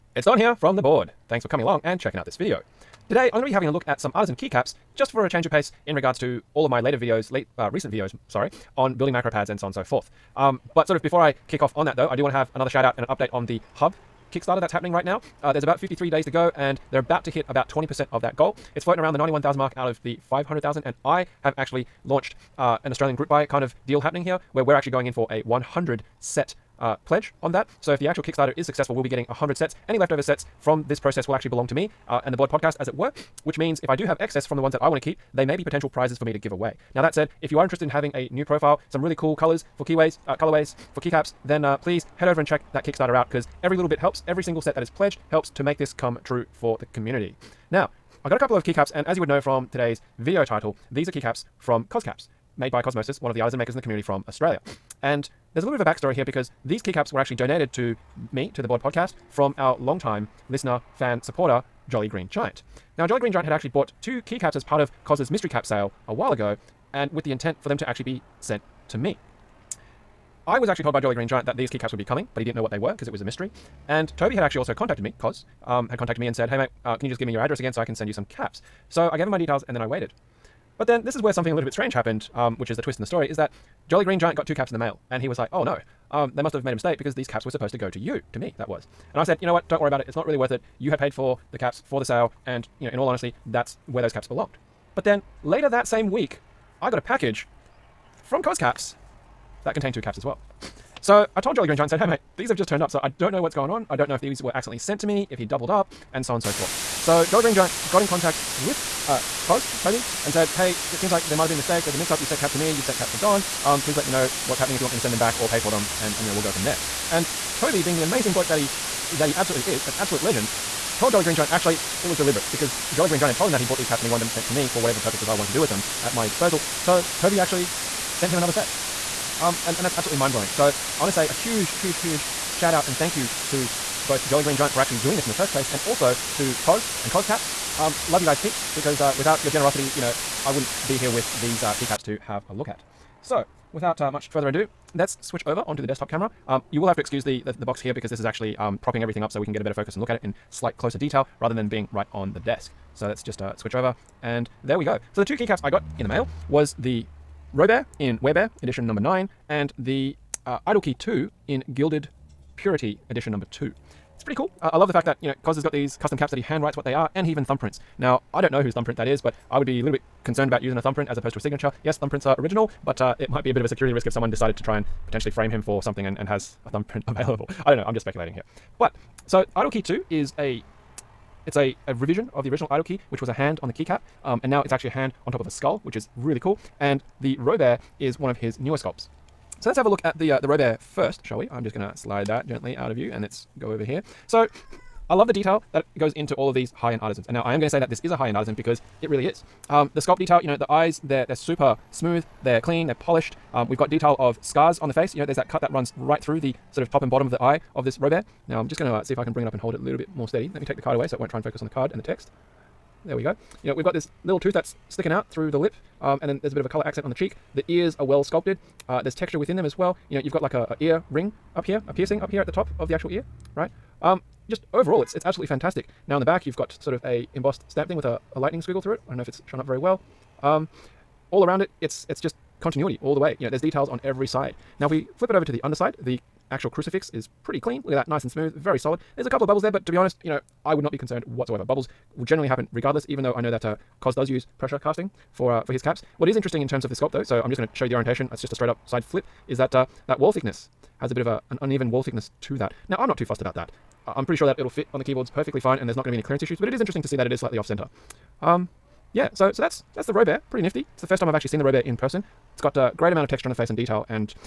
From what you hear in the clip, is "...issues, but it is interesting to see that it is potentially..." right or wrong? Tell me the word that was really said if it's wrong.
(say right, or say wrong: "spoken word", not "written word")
wrong: "slightly", not "potentially".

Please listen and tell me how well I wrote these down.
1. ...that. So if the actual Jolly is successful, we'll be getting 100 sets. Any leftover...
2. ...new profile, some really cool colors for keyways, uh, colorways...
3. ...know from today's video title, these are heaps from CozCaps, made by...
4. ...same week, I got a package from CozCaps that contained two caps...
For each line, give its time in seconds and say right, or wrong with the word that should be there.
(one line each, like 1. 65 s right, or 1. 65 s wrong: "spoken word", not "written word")
1. 27 s wrong: "Kickstarter", not "Jolly"
2. 38 s right
3. 49 s wrong: "keycaps", not "heaps"
4. 95 s right.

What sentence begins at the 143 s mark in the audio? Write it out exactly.
So, without uh, much further ado, let's switch over onto the desktop camera.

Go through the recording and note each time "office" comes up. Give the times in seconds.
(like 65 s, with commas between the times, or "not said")
not said.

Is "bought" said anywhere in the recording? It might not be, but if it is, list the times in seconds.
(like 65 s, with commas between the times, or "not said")
63 s, 123 s.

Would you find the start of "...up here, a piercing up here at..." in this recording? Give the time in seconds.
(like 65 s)
221 s.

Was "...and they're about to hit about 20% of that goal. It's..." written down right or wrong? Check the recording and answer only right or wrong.
right.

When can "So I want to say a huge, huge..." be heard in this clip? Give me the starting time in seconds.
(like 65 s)
130 s.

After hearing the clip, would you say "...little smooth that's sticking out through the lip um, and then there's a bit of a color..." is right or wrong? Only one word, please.
wrong.